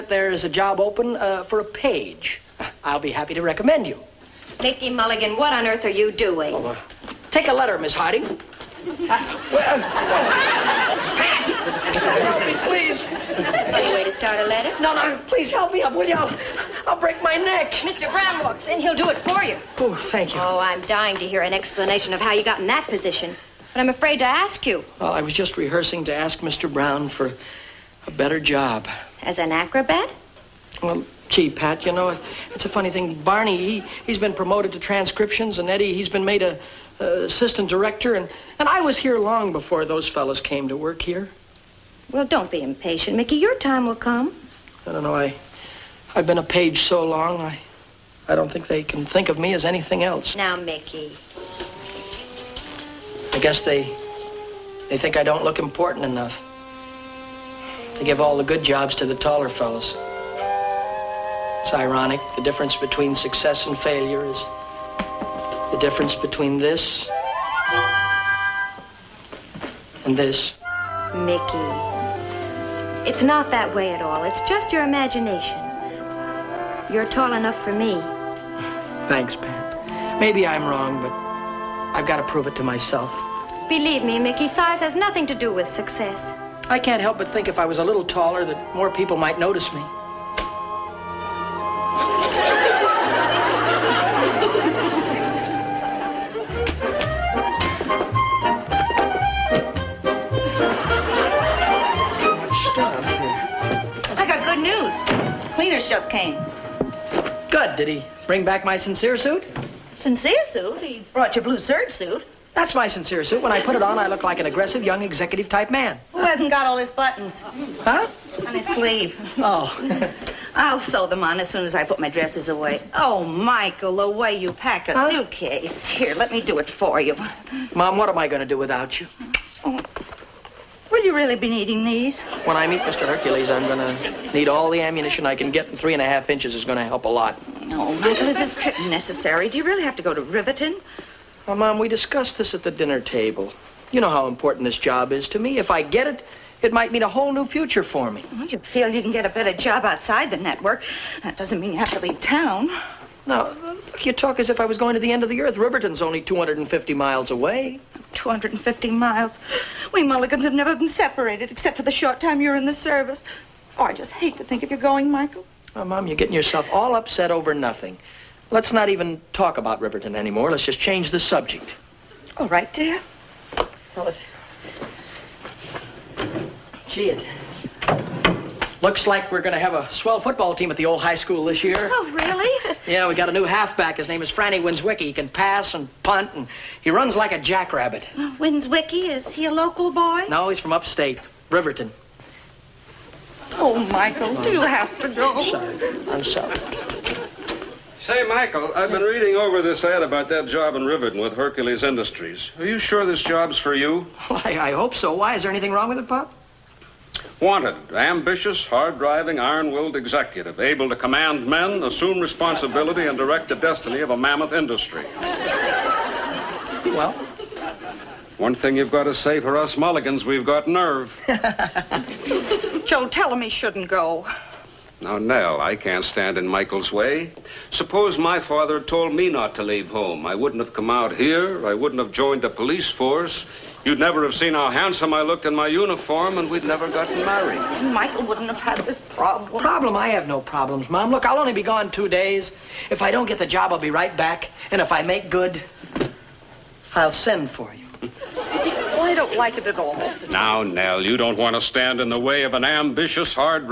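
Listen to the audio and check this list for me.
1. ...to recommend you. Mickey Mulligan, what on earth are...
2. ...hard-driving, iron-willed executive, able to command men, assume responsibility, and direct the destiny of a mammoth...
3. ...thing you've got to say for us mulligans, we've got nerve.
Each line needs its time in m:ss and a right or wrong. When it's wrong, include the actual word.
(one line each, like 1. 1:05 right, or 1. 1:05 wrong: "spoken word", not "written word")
1. 0:03 right
2. 3:28 right
3. 3:38 right.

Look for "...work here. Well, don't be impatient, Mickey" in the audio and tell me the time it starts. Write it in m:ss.
0:40.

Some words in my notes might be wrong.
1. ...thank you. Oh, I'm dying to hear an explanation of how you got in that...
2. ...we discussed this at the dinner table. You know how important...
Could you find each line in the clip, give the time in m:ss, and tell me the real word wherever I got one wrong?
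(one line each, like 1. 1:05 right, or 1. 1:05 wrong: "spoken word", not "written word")
1. 0:20 right
2. 2:21 right.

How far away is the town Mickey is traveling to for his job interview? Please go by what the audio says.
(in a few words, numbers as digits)
250 miles.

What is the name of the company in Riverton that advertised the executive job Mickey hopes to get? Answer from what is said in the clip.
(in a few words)
Hercules Industries.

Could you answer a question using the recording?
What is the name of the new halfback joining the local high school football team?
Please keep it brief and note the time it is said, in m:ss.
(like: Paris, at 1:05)
Franny Winswicki, at 3:04.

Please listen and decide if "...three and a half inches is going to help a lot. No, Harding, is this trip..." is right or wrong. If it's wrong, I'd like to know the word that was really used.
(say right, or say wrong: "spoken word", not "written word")
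wrong: "Michael", not "Harding".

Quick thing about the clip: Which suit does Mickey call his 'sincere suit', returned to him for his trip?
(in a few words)
blue serge suit.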